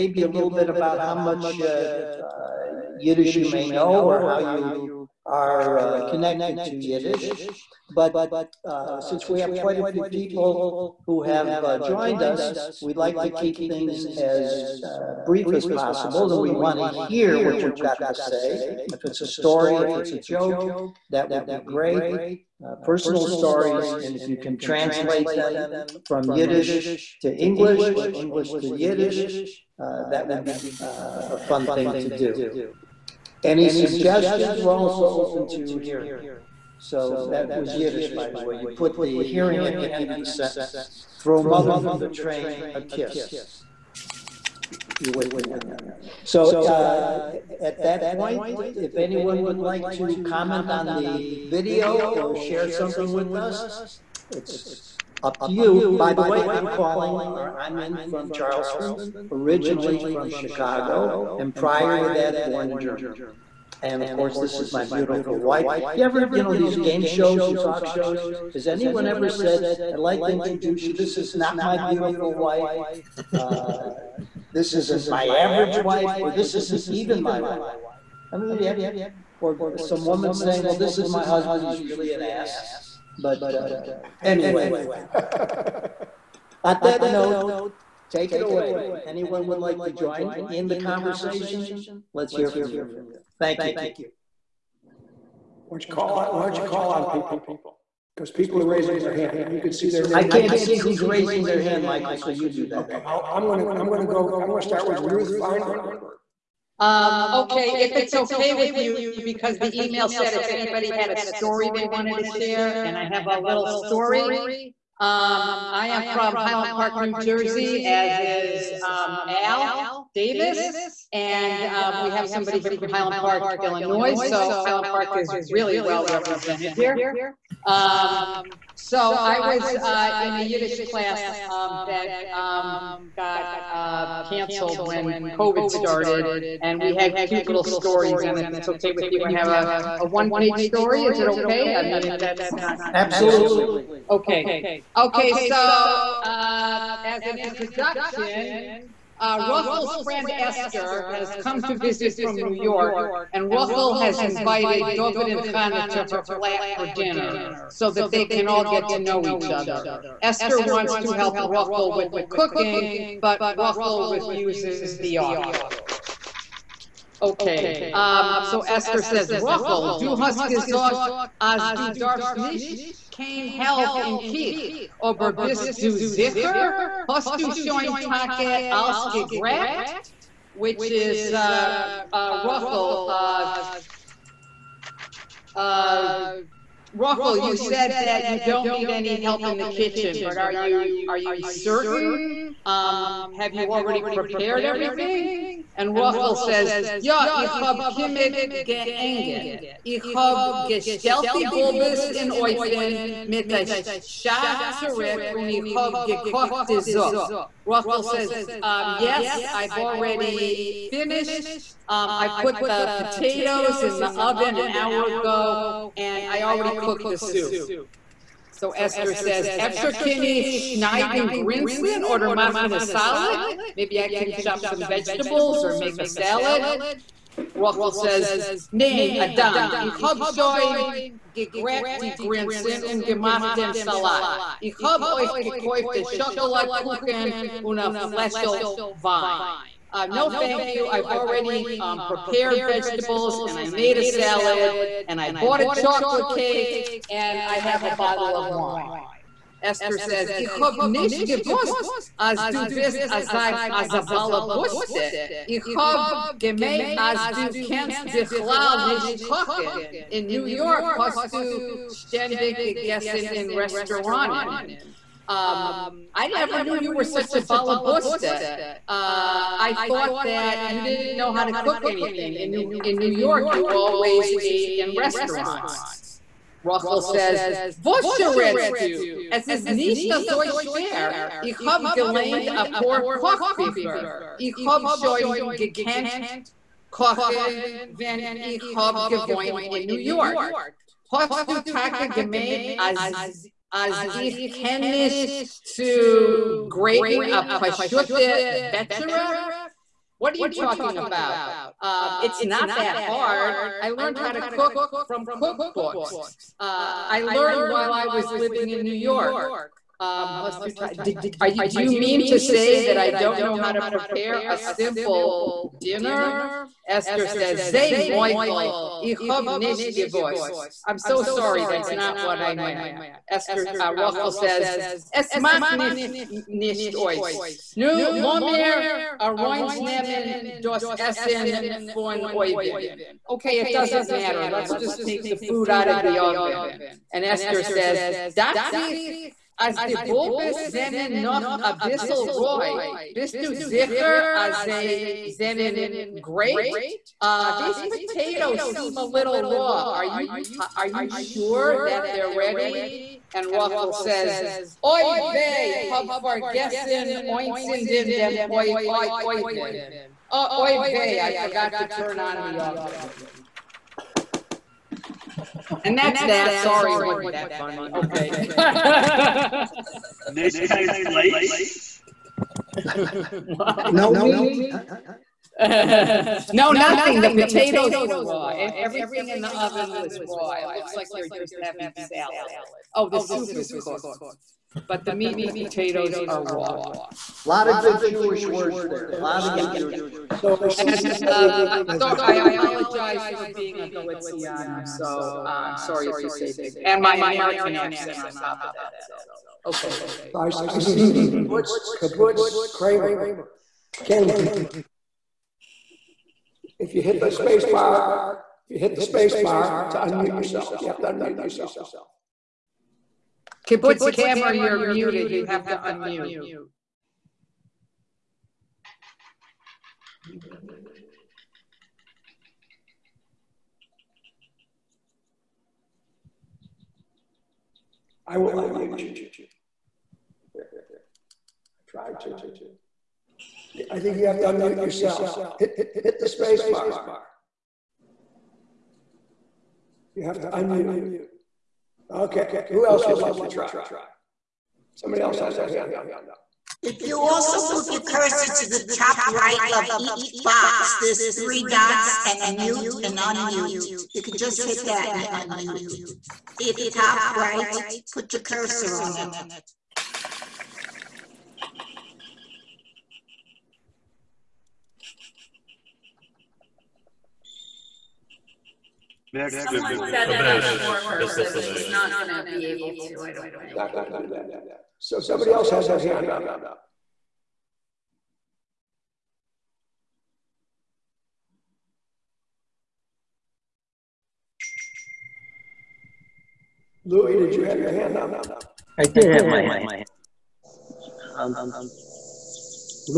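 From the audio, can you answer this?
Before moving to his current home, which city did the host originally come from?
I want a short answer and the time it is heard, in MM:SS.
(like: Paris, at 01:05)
Chicago, at 01:00.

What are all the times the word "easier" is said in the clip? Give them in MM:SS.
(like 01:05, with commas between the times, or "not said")
not said.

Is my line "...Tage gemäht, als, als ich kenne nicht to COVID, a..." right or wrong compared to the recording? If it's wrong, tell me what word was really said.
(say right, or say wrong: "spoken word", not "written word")
wrong: "Grayton", not "COVID".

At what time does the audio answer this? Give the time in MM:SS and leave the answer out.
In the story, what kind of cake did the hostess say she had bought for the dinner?
04:05.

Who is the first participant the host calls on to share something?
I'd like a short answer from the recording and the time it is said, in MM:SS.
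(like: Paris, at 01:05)
Ruth Feinberg, at 01:45.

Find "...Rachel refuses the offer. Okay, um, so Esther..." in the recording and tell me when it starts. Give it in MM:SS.
02:43.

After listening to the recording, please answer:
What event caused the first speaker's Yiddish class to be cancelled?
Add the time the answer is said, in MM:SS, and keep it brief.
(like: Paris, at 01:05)
COVID, at 02:15.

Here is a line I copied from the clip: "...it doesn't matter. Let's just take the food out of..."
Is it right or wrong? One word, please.
right.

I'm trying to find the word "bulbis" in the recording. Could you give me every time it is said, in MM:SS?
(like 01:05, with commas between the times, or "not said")
03:21, 05:39.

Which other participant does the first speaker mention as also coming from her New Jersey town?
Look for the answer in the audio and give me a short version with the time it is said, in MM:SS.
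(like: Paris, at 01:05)
Al Davis, at 01:59.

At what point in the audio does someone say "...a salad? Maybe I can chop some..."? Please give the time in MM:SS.
03:42.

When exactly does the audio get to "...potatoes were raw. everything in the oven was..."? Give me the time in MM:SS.
06:17.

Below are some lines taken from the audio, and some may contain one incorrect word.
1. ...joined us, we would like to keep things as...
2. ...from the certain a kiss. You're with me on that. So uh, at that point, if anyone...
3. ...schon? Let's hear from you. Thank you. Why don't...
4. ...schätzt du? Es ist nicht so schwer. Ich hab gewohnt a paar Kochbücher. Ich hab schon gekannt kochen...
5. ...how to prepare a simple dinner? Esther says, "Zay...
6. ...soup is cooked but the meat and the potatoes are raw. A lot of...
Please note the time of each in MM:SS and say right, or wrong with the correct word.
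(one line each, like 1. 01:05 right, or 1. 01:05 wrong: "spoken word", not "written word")
1. 00:11 right
2. 00:41 wrong: "train", not "certain"
3. 01:30 wrong: "conversation", not "schon"
4. 04:38 wrong: "gelernt", not "gewohnt"
5. 05:13 right
6. 06:23 right.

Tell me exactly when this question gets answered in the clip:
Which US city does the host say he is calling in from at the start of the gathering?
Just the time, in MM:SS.
00:58.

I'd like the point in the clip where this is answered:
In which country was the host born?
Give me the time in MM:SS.
01:02.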